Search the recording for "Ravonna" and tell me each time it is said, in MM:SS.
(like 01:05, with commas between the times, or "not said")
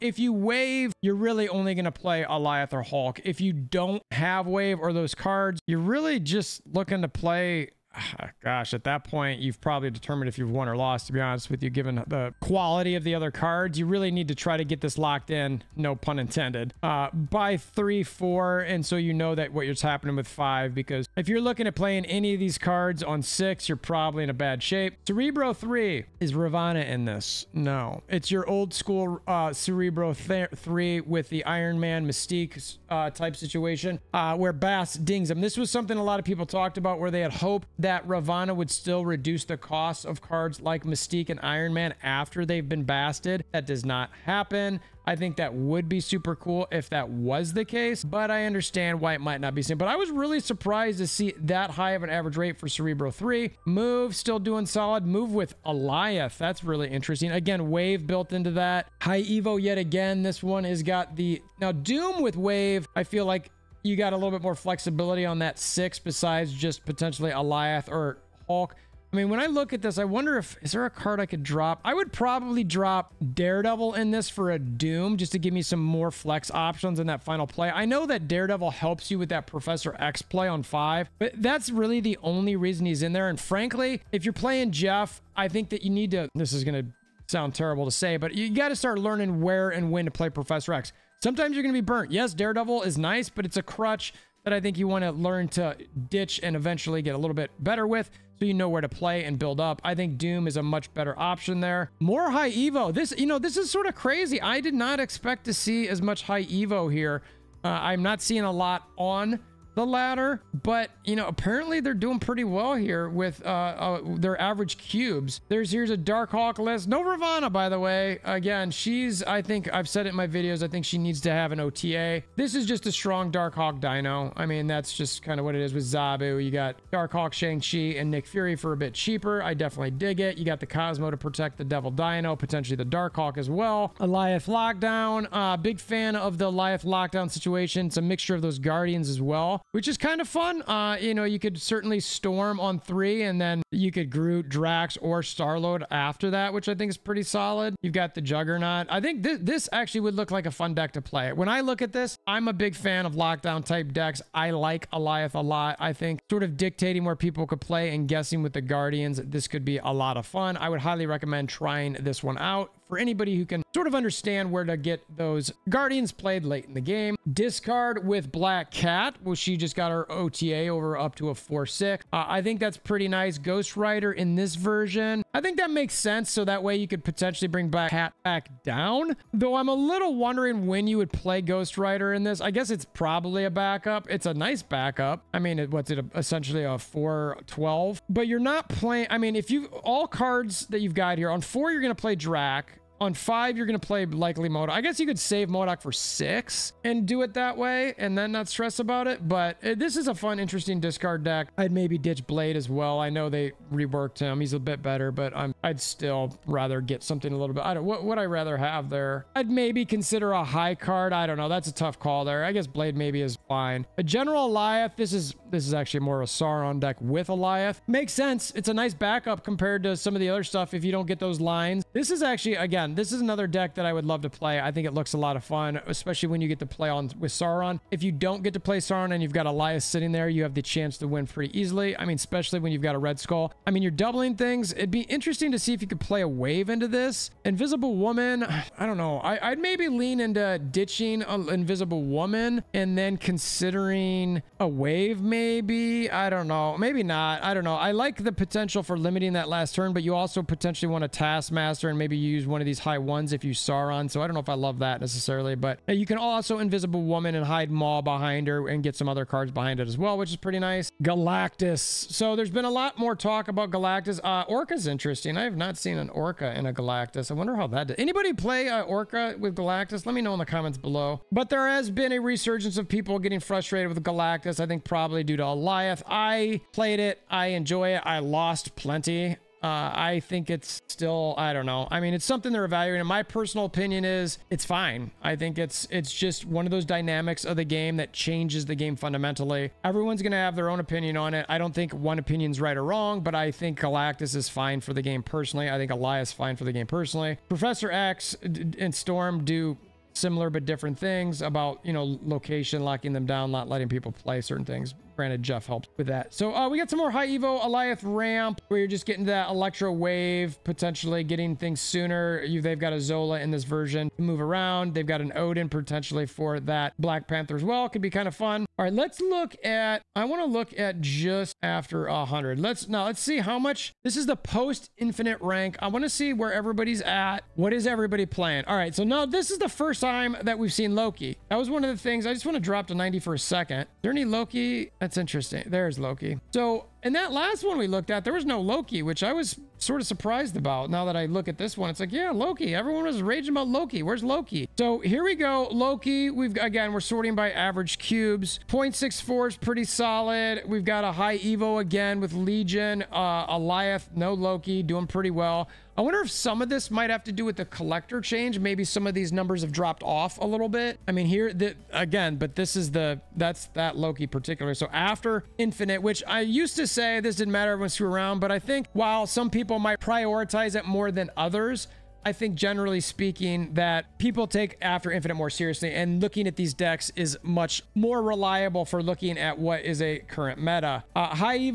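00:26, 00:38, 01:57.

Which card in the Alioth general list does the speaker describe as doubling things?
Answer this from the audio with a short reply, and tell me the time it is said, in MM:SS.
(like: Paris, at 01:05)
Red Skull, at 03:52.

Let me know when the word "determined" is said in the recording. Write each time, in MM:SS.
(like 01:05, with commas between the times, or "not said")
00:09.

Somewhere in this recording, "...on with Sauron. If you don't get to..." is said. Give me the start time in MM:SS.
03:46.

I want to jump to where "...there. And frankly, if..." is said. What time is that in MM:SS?
01:23.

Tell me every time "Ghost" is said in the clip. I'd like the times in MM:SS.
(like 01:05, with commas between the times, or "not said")
02:53, 03:01.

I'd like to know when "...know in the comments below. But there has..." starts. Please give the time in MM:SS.
04:30.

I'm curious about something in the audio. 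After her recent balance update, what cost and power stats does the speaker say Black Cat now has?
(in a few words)
4-6.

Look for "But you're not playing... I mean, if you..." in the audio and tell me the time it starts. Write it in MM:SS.
03:08.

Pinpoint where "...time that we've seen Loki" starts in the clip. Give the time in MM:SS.
05:30.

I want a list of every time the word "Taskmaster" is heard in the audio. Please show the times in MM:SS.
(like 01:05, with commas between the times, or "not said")
04:11.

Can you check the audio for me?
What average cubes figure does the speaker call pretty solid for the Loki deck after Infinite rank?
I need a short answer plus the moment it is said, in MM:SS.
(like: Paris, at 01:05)
0.64, at 05:48.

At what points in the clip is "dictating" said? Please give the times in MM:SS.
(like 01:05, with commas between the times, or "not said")
02:36.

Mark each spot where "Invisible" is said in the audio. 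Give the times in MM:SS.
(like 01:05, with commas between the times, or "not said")
03:57, 04:01, 04:16.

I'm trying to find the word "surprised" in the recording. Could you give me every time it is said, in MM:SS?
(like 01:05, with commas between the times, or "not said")
00:50, 05:40.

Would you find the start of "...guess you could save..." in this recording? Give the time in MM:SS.
03:14.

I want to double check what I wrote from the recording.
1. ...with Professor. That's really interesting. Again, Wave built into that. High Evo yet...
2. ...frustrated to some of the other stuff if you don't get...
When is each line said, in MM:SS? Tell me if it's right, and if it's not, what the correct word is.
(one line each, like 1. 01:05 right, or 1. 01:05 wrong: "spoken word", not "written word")
1. 00:55 wrong: "Alioth", not "Professor"
2. 03:39 wrong: "compared", not "frustrated".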